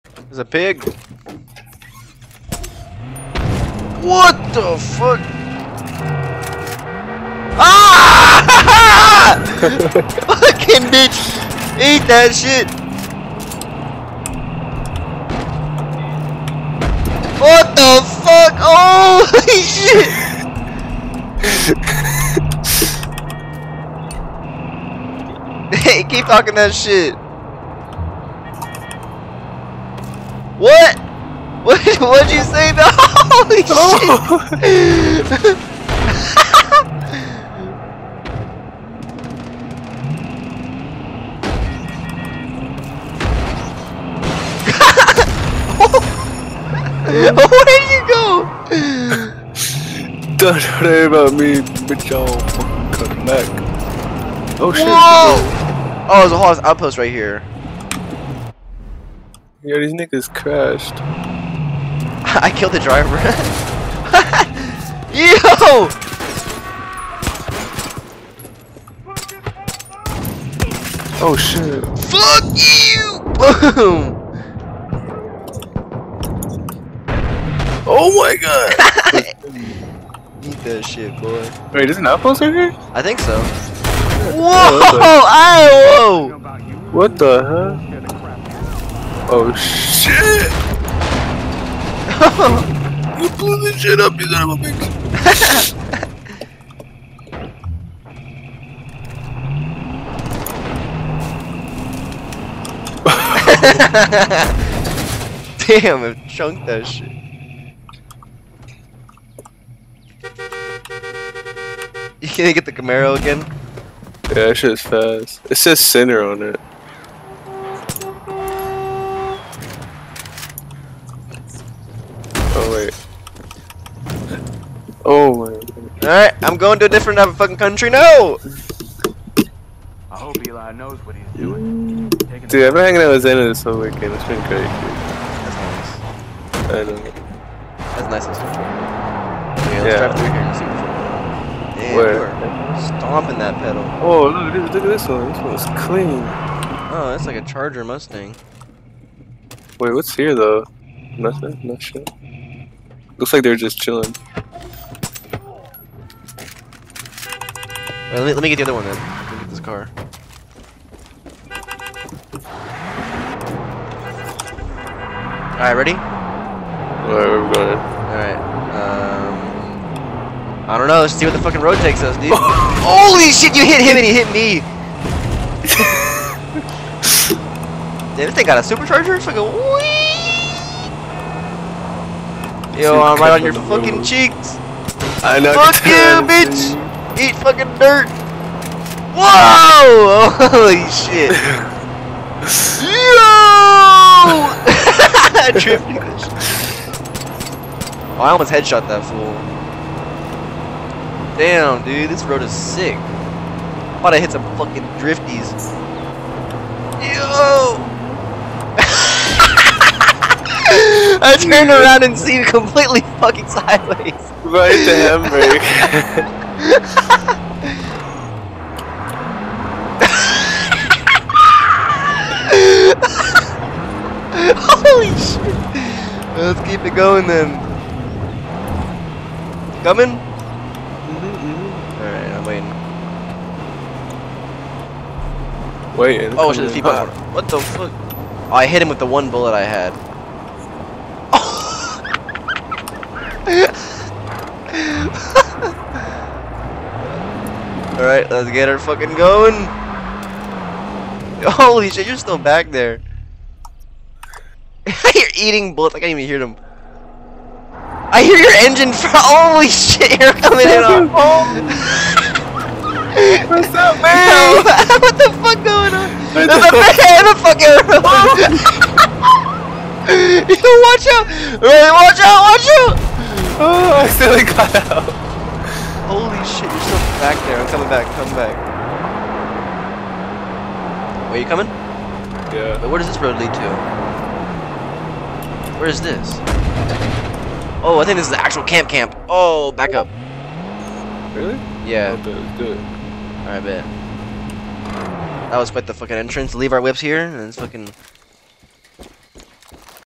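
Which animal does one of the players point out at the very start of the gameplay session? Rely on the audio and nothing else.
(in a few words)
pig.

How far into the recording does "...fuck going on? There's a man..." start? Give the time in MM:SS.
04:25.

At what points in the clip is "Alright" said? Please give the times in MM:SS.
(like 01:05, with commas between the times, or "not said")
02:06, 03:52, 04:03, 04:53.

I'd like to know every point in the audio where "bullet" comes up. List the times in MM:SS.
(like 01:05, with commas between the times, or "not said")
03:59, 04:15.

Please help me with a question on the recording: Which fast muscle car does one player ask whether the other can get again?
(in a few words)
Camaro.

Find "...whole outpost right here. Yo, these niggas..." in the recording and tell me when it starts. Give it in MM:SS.
00:56.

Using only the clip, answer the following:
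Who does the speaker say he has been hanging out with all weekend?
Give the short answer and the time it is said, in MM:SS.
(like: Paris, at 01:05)
Xena, at 02:13.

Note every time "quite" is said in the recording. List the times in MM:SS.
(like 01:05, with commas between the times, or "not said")
04:55.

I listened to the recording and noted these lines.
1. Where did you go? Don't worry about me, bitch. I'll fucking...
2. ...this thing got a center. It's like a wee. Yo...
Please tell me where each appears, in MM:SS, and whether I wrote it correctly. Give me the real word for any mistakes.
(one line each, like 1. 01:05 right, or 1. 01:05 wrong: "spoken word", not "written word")
1. 00:47 right
2. 02:58 wrong: "supercharger", not "center".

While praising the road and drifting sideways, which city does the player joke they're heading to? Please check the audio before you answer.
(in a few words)
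Hamburg.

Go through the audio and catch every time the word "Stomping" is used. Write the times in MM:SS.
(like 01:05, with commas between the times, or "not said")
02:22.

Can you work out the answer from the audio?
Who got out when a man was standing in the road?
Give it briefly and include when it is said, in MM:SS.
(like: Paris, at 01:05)
Tyler, at 04:34.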